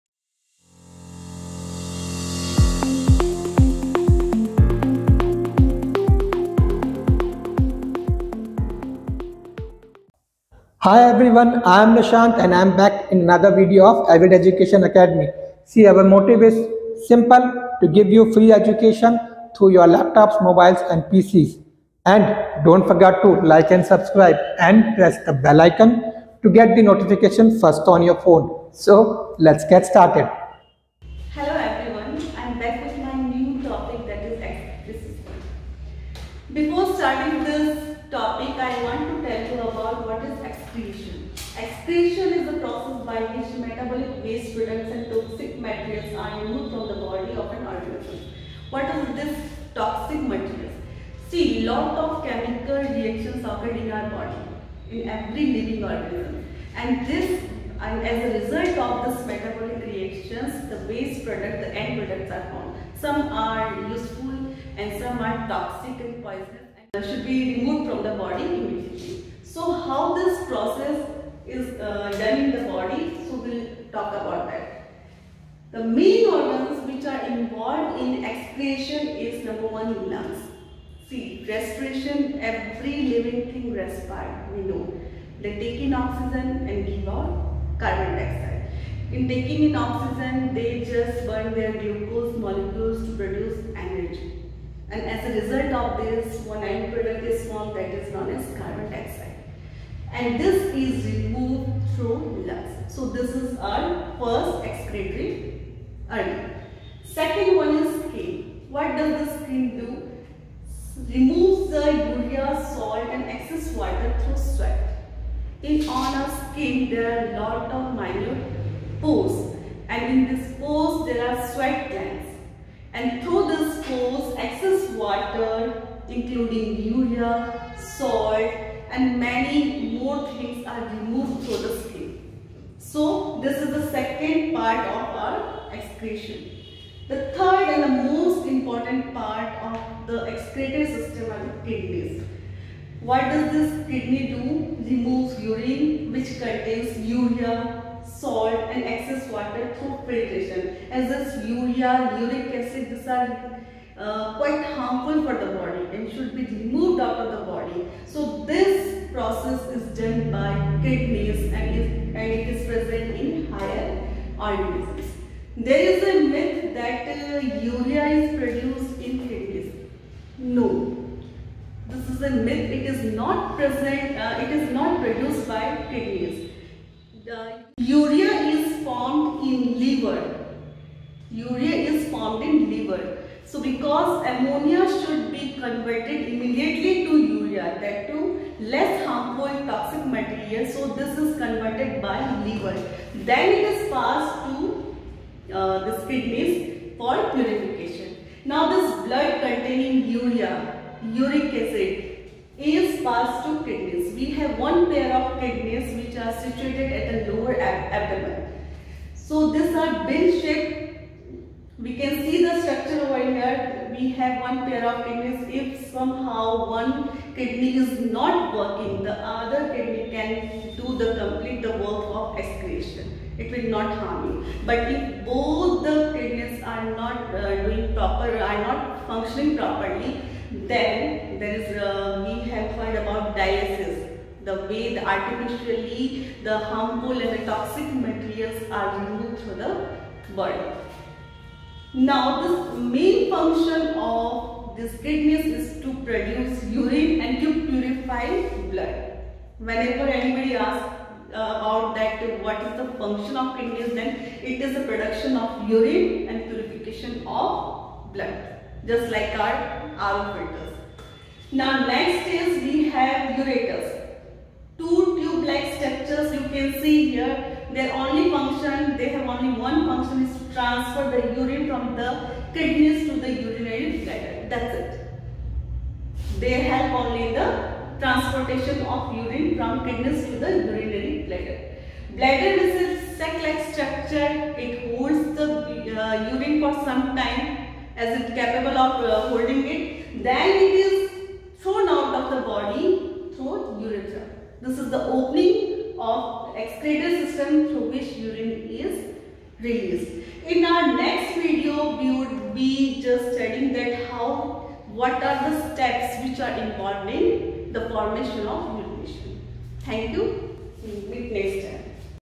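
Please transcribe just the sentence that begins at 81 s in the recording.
See, respiration, every living thing respires, we know.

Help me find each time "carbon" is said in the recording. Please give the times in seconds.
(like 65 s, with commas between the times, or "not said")
87 s, 98 s.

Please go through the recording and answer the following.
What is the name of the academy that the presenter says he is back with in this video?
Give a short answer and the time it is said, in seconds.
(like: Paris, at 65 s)
Avid Education Academy, at 14 s.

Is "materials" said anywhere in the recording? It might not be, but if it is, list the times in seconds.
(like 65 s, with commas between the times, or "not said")
45 s, 50 s, 238 s.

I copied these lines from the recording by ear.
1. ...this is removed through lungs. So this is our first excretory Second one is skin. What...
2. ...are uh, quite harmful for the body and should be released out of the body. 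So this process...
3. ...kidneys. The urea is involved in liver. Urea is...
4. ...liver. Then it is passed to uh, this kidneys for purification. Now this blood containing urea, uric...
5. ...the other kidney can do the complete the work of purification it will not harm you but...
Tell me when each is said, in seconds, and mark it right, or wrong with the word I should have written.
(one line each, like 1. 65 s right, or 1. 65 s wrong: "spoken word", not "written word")
1. 100 s right
2. 153 s wrong: "removed", not "released"
3. 175 s wrong: "formed", not "involved"
4. 192 s right
5. 219 s wrong: "excretion", not "purification".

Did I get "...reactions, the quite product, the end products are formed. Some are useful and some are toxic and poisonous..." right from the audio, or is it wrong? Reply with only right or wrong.
wrong.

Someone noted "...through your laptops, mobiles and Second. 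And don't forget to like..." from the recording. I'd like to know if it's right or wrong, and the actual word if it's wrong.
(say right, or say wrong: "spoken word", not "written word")
wrong: "PCs", not "Second".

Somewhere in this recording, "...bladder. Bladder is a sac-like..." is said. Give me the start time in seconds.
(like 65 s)
281 s.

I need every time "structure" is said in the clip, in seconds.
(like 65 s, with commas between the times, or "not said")
212 s, 265 s, 283 s.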